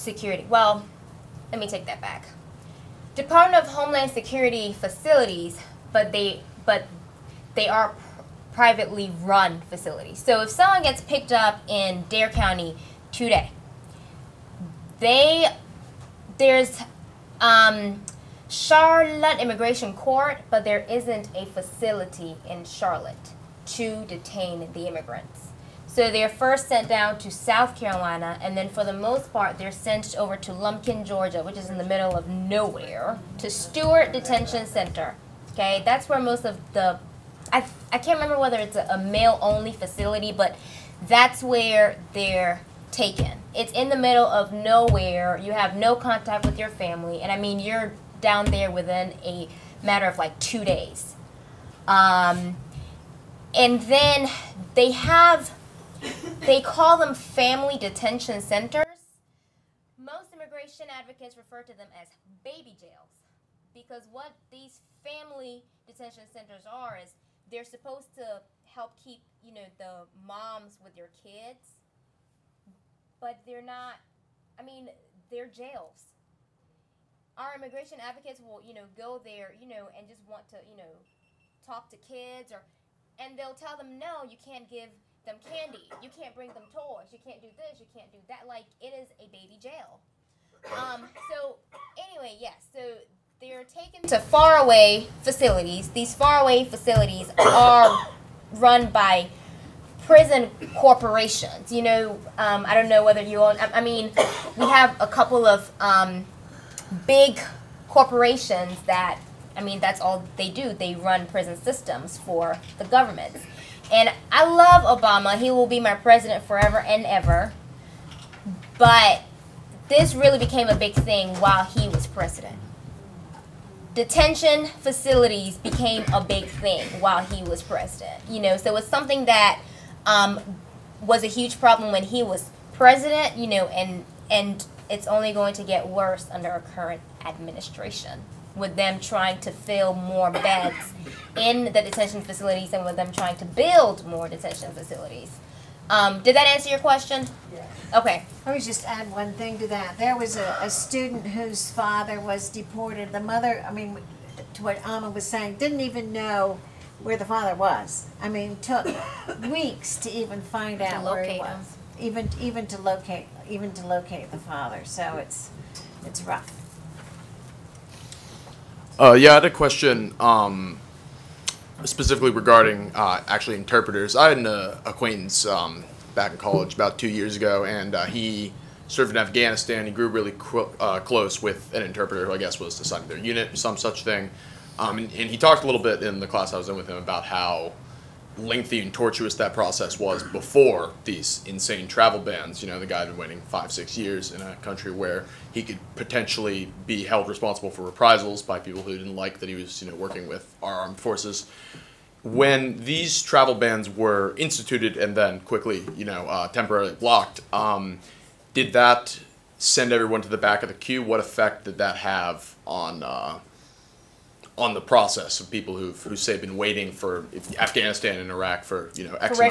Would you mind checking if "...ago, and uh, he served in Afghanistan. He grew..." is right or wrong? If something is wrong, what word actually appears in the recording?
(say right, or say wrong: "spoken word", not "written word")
right.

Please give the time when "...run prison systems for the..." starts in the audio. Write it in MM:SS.
01:50.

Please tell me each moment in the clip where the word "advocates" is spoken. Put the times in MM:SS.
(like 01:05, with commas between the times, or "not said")
01:00, 01:17.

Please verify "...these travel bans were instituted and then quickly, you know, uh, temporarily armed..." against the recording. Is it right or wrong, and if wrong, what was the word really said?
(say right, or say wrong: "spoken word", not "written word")
wrong: "blocked", not "armed".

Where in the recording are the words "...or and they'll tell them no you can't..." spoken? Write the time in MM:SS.
01:22.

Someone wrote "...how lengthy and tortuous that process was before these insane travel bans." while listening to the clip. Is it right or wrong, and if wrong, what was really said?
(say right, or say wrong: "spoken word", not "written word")
right.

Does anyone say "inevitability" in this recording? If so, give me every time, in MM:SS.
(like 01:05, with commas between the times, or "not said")
not said.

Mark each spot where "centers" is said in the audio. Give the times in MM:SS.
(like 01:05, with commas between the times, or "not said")
00:34, 00:58, 01:06.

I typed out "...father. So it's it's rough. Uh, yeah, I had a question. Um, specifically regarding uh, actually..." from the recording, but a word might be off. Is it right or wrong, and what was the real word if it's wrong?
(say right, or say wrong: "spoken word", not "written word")
right.